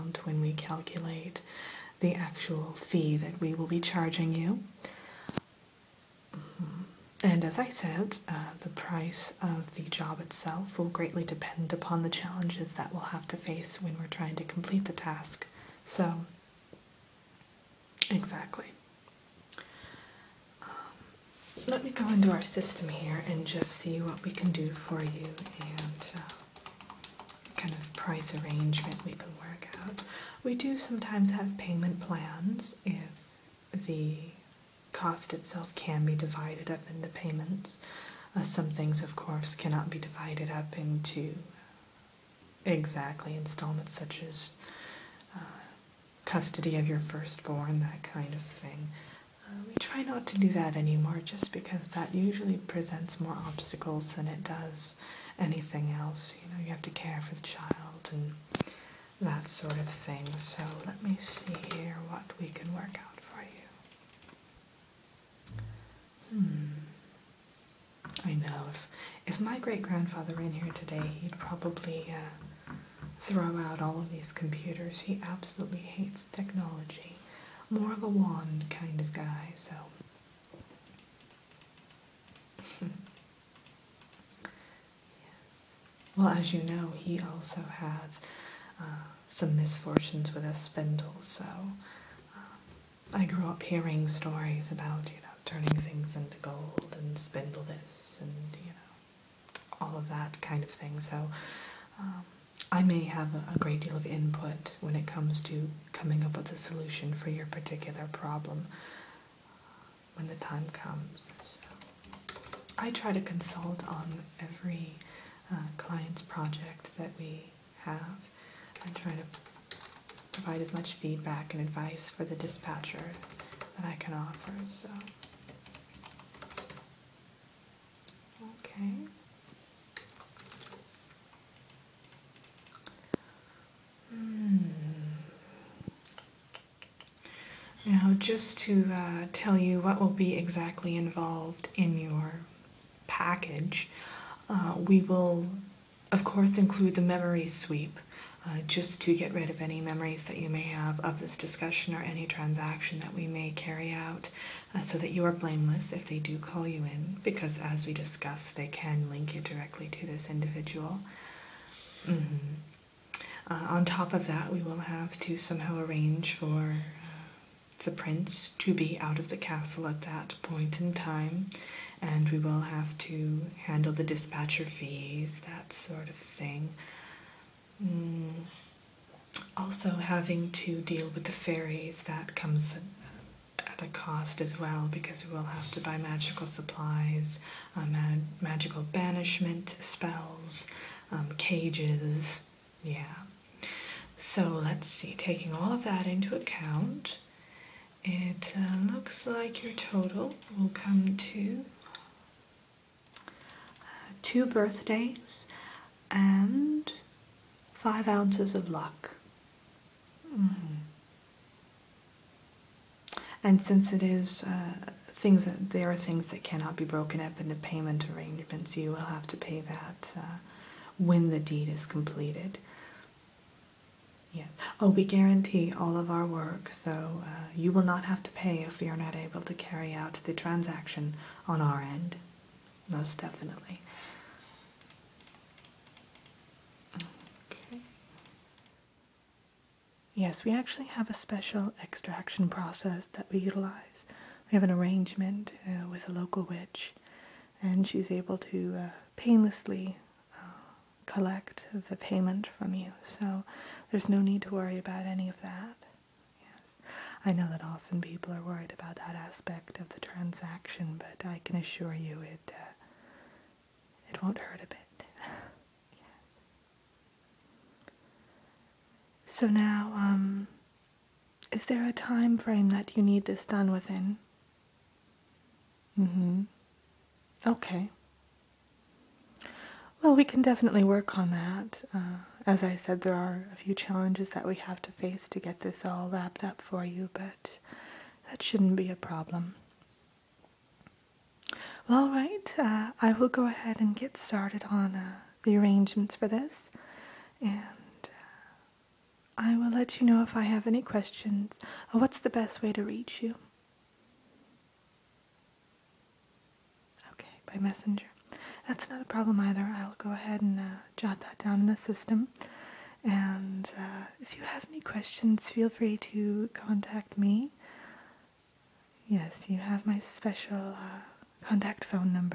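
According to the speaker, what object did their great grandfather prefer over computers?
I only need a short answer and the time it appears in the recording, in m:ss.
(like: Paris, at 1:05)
a wand, at 1:18.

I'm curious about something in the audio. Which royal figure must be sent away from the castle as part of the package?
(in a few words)
the prince.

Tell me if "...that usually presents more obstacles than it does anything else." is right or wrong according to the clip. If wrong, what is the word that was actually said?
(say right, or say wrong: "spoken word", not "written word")
right.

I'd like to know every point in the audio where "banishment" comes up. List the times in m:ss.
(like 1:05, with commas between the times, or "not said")
3:08.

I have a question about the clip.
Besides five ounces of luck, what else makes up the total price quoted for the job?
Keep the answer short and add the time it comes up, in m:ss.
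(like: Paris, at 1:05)
2 birthdays, at 3:24.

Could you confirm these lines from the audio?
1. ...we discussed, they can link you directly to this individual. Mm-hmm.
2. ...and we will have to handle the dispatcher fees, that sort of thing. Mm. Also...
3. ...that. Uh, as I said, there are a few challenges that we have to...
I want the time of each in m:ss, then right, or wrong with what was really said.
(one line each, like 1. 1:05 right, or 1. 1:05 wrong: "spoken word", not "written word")
1. 2:37 right
2. 2:51 right
3. 4:41 right.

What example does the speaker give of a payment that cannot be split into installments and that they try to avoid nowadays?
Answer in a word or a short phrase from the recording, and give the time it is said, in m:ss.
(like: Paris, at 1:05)
custody of your firstborn, at 0:46.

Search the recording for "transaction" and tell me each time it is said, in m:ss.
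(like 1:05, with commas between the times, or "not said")
2:32, 3:50, 4:19.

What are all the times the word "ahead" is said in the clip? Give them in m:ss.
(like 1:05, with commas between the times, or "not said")
4:53, 5:10.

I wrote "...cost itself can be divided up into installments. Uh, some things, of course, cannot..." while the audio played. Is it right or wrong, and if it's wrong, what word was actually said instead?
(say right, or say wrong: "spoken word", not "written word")
wrong: "payments", not "installments".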